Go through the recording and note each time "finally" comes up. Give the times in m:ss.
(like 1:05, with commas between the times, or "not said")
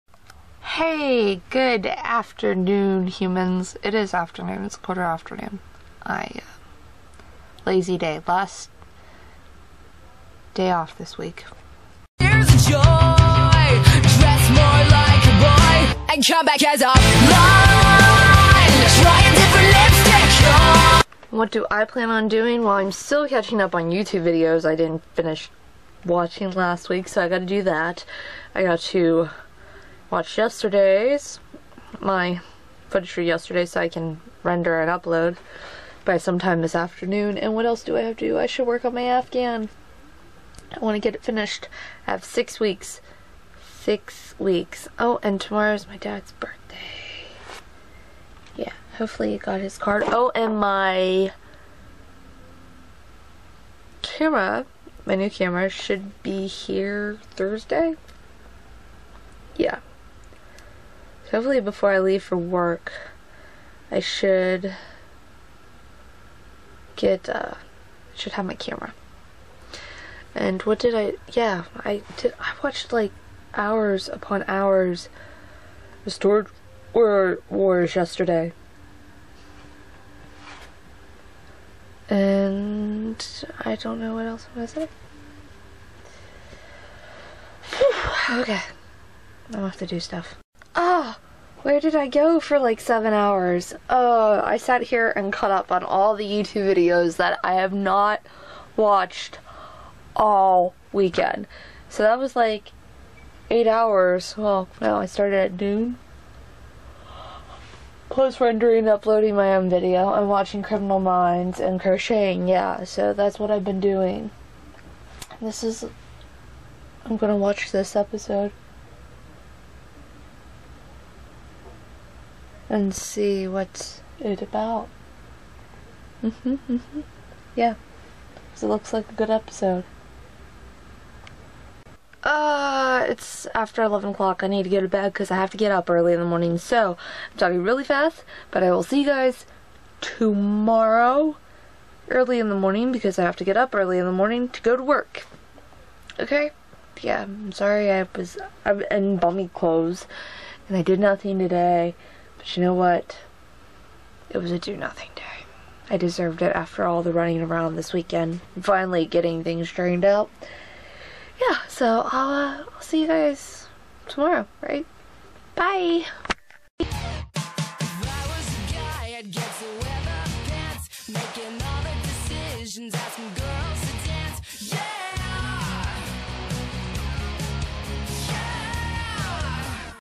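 2:38.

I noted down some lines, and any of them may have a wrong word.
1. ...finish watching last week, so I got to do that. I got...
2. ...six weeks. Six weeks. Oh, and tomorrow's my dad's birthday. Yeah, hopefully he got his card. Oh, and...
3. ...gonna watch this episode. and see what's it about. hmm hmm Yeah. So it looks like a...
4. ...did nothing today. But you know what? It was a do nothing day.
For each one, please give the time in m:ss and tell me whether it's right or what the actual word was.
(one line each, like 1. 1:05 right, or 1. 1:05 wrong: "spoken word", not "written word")
1. 0:25 right
2. 0:42 right
3. 1:57 right
4. 2:30 right.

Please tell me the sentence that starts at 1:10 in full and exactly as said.
And what did I, yeah, I did, I watched like hours upon hours of Storage Wars yesterday.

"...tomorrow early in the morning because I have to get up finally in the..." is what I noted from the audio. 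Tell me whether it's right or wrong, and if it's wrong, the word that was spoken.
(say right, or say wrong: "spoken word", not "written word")
wrong: "early", not "finally".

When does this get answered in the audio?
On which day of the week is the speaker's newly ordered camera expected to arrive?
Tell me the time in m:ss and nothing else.
0:57.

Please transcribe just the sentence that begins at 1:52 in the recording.
Yeah, so that's what I've been doing.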